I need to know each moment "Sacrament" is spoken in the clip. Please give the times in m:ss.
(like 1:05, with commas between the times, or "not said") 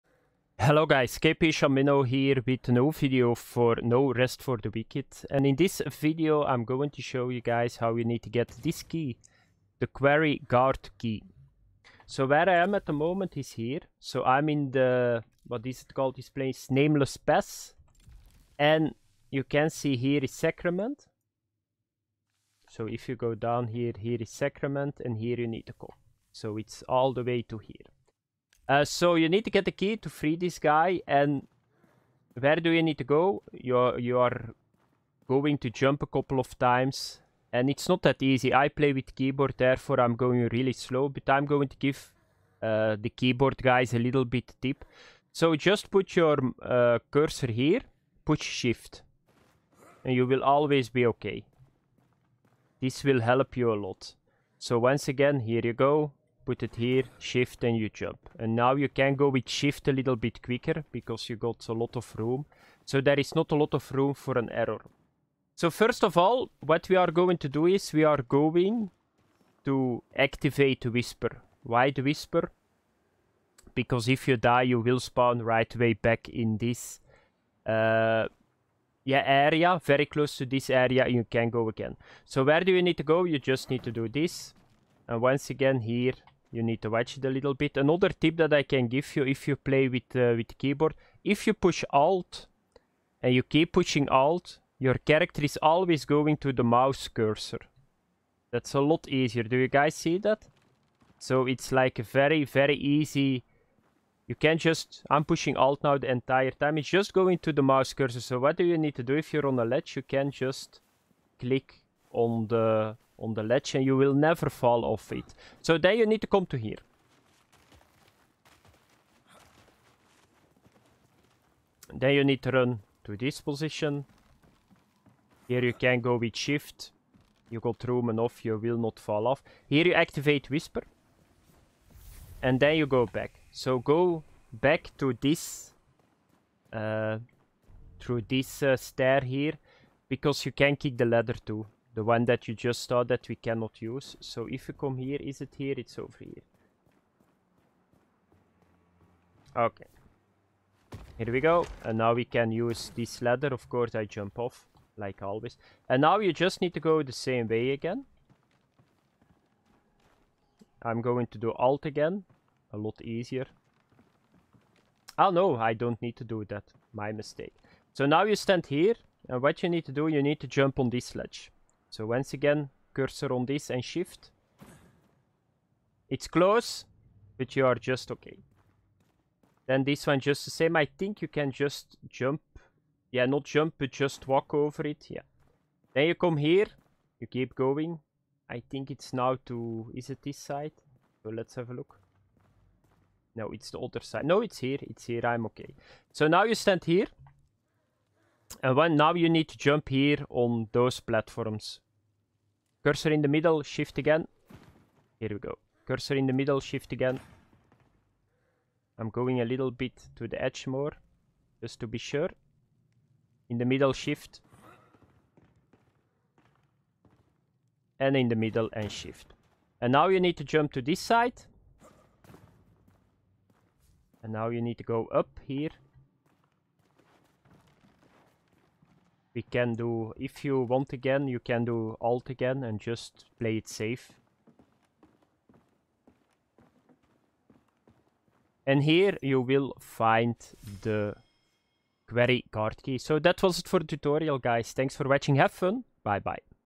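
0:20, 0:24.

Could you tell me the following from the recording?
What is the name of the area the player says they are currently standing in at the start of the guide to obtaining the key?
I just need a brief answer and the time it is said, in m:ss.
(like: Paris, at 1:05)
Nameless Pass, at 0:16.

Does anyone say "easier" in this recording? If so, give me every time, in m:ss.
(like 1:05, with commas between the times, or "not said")
1:39, 2:43.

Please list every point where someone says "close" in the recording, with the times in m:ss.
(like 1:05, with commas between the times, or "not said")
1:20, 2:56.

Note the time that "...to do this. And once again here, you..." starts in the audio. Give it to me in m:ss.
1:23.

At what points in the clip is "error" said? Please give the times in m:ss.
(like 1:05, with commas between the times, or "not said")
1:04.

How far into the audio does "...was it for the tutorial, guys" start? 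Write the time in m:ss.
4:03.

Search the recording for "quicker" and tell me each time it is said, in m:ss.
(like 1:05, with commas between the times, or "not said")
1:00.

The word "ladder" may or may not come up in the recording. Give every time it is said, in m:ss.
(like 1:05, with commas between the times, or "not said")
2:21, 2:33.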